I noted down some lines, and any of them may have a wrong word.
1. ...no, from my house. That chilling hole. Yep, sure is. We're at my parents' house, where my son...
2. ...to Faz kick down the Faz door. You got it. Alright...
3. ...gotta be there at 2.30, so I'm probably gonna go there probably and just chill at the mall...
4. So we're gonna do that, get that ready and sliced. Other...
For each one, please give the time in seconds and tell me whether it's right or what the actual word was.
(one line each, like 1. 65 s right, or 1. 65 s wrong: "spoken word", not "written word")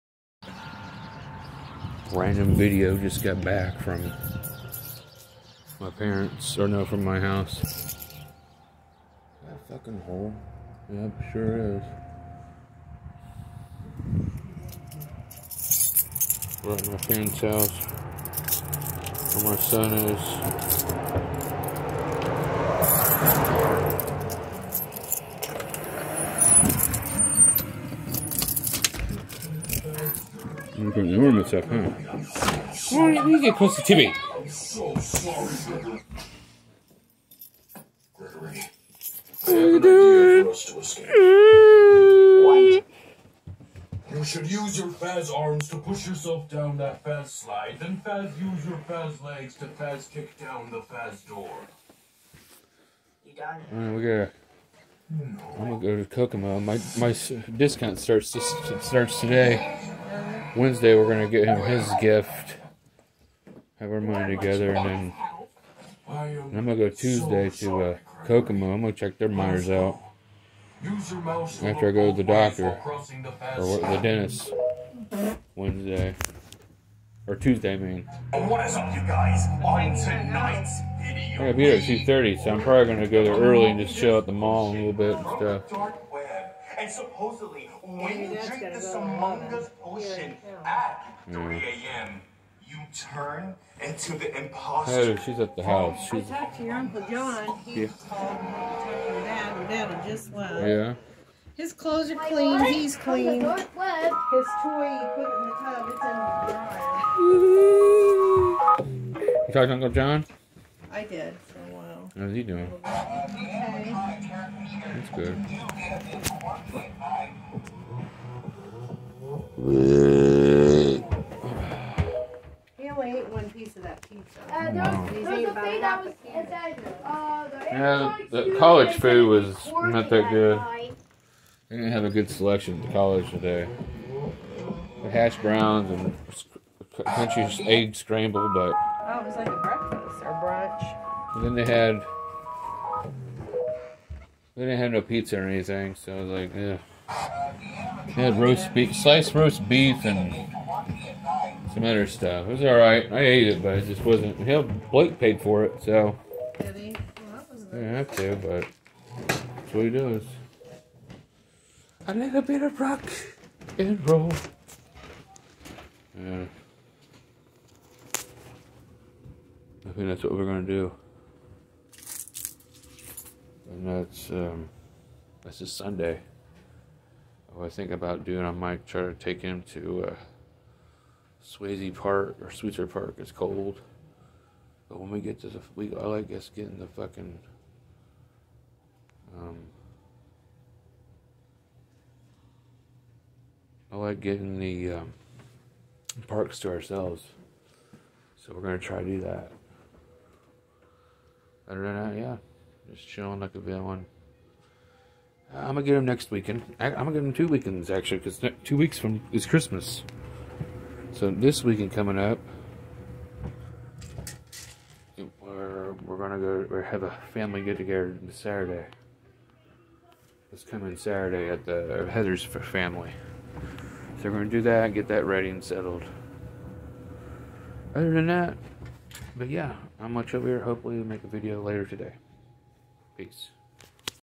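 1. 6 s wrong: "fucking", not "chilling"
2. 49 s right
3. 81 s wrong: "early", not "probably"
4. 224 s wrong: "settled", not "sliced".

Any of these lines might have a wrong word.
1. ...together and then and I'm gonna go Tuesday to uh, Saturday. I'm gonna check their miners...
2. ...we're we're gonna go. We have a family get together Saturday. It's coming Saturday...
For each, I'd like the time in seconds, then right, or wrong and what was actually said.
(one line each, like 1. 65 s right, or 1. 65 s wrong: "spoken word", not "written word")
1. 64 s wrong: "Kokomo", not "Saturday"
2. 215 s right.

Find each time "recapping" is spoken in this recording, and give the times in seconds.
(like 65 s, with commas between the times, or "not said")
not said.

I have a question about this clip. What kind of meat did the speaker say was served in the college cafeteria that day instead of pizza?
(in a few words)
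Sliced roast beef.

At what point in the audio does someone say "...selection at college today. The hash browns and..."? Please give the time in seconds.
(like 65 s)
132 s.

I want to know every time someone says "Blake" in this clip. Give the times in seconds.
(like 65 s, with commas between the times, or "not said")
154 s.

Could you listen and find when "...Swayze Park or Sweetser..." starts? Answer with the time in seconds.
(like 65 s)
181 s.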